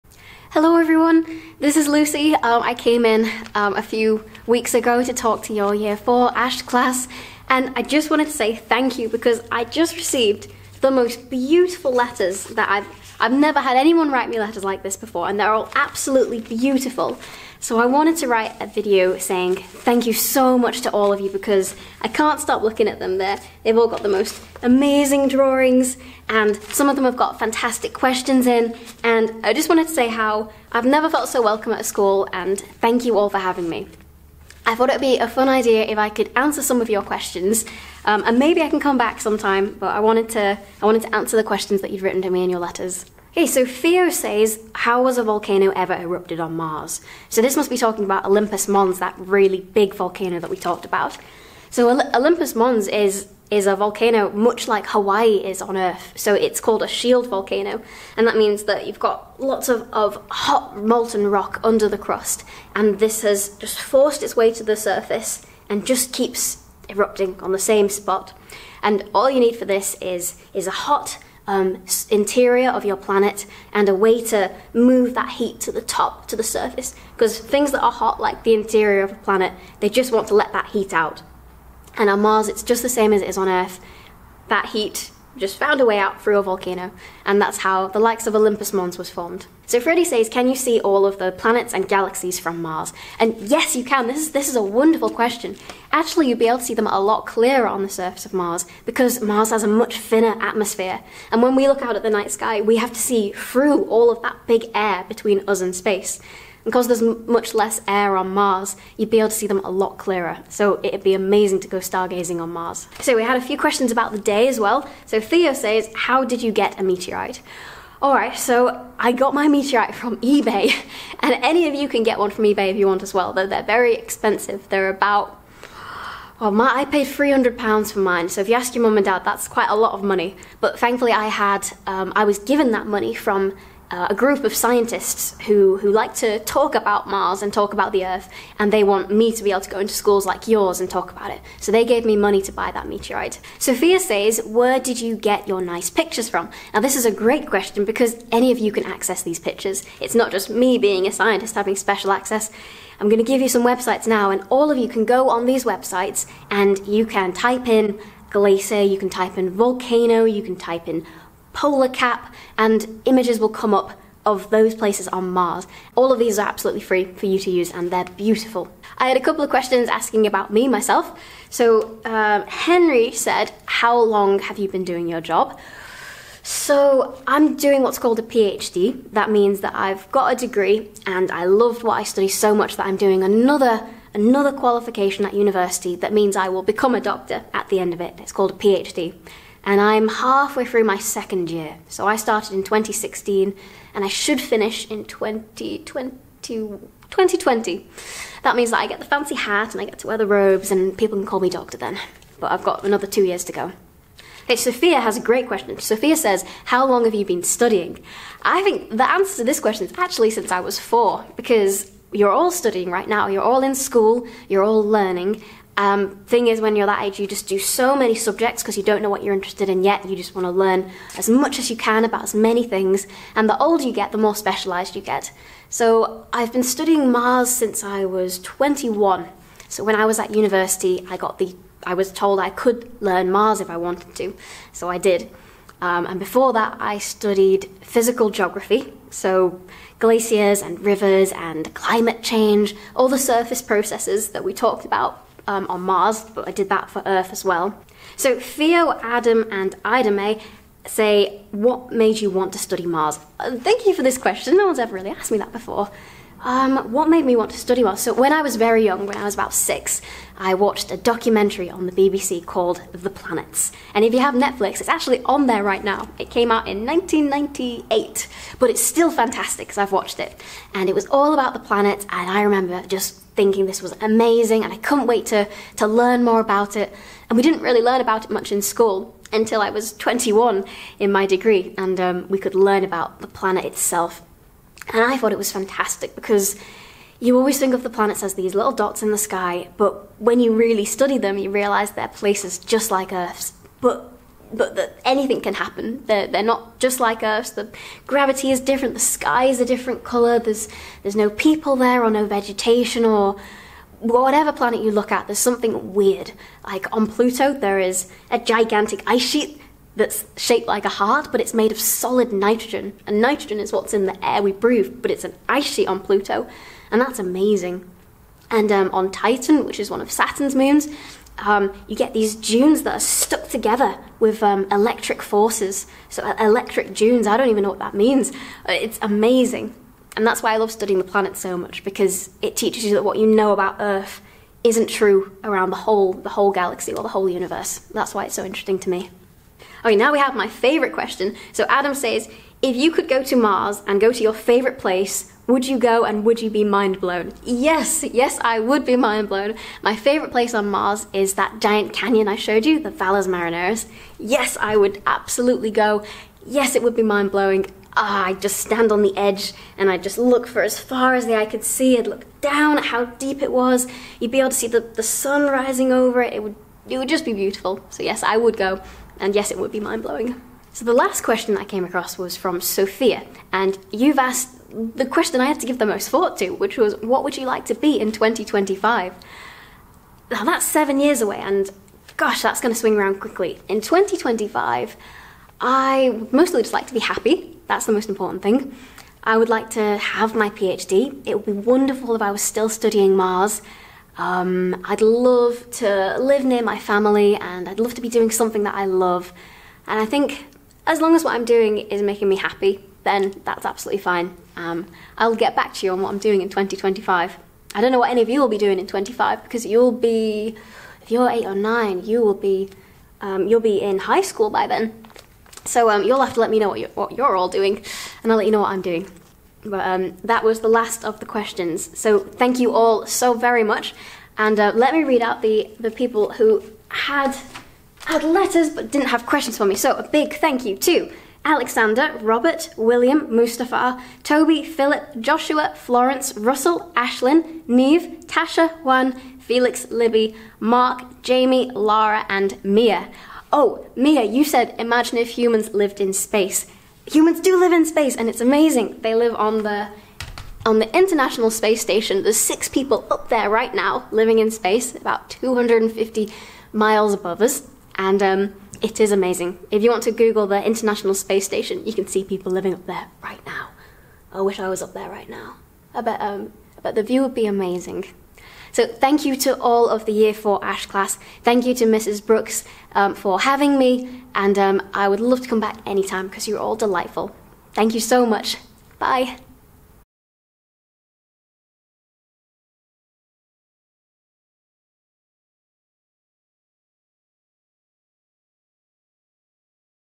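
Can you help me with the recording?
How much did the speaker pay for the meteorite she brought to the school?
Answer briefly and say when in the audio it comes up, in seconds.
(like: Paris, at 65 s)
£300, at 127 s.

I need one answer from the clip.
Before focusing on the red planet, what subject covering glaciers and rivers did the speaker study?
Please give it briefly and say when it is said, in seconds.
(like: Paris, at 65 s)
Physical geography, at 237 s.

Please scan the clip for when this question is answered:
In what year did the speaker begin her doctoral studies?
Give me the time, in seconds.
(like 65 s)
192 s.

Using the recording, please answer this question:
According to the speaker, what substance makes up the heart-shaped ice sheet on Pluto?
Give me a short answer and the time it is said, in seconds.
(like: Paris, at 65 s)
Solid nitrogen, at 311 s.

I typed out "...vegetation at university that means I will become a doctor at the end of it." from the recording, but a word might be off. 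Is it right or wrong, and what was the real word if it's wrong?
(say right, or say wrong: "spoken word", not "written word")
wrong: "qualification", not "vegetation".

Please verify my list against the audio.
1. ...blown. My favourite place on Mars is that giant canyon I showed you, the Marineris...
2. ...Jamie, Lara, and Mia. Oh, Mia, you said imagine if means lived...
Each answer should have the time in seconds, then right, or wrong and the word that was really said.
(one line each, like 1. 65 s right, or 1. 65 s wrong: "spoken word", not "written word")
1. 349 s wrong: "Valles", not "Marineris"
2. 441 s wrong: "humans", not "means".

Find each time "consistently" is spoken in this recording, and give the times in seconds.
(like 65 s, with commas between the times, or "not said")
not said.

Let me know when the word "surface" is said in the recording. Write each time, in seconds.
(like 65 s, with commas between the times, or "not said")
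64 s, 76 s, 97 s, 243 s.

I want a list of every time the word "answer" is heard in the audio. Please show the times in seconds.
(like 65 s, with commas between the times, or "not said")
36 s, 41 s, 209 s.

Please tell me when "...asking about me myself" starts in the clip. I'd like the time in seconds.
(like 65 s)
169 s.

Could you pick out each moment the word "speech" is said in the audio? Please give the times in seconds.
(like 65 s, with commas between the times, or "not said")
not said.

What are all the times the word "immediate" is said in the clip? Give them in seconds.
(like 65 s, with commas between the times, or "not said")
not said.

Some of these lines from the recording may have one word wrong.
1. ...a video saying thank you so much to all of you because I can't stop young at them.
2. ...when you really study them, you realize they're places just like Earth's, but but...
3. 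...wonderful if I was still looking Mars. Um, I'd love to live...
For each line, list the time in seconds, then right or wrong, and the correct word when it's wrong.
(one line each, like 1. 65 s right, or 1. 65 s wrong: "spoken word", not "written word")
1. 18 s wrong: "looking", not "young"
2. 290 s right
3. 391 s wrong: "studying", not "looking".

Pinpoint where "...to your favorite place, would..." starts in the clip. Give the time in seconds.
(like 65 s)
344 s.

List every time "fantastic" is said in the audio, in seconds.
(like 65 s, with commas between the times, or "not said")
27 s, 269 s, 285 s.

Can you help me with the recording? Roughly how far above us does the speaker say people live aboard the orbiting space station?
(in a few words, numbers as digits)
250 miles.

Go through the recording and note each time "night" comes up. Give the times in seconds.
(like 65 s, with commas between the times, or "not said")
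102 s.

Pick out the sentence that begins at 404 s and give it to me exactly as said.
Um, I'll get back to you on what I'm doing in 2025.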